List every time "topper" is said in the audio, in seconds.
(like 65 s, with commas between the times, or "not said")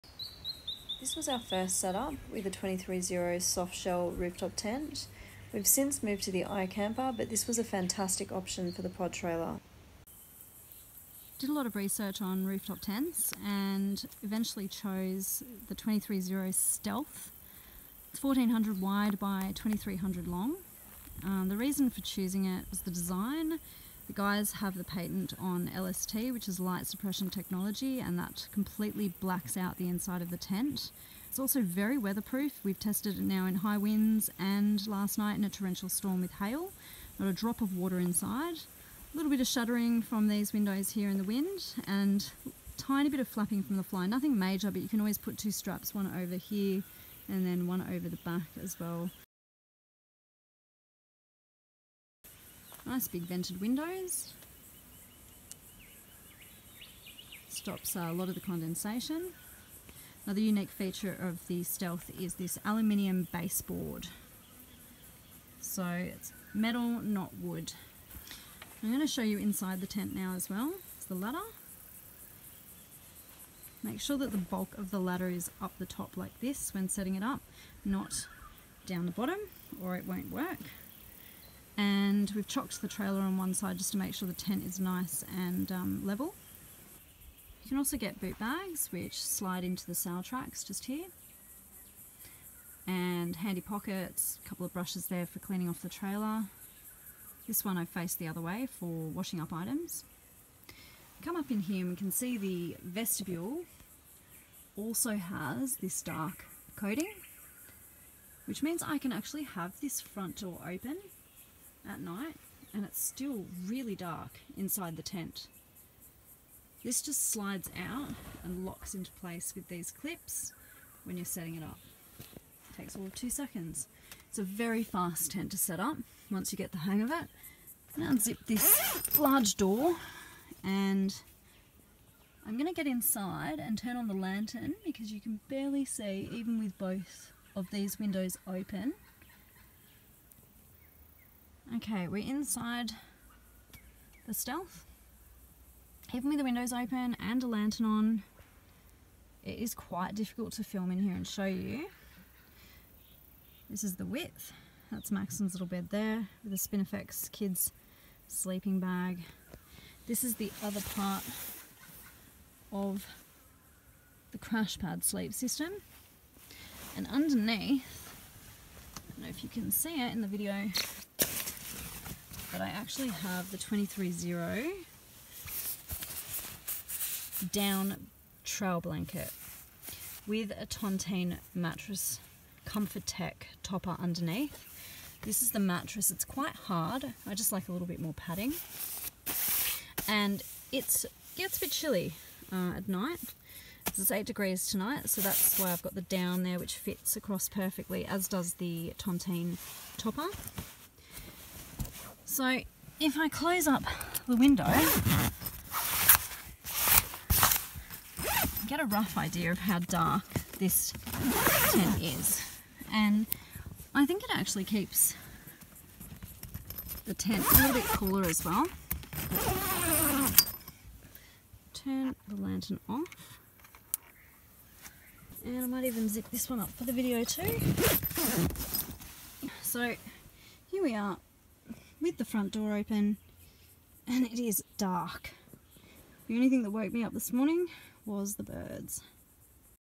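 183 s, 199 s.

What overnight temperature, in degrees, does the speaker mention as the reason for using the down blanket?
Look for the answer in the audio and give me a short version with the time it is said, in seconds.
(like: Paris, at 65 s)
8 degrees, at 194 s.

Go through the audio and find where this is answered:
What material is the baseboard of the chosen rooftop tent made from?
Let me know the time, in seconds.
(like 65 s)
62 s.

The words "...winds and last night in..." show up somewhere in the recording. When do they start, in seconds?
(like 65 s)
33 s.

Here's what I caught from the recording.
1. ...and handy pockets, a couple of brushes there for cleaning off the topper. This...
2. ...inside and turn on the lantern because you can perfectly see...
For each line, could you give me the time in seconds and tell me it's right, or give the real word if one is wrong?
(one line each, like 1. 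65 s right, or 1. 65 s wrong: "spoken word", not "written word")
1. 92 s wrong: "trailer", not "topper"
2. 132 s wrong: "barely", not "perfectly".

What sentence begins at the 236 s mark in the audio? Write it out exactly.
The only thing that woke me up this morning was the birds.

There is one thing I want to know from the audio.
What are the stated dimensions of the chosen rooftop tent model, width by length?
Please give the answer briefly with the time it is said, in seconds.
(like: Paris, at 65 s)
1400 by 2300, at 18 s.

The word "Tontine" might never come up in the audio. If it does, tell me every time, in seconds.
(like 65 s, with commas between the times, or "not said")
180 s, 198 s.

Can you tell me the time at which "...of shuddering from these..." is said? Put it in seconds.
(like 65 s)
39 s.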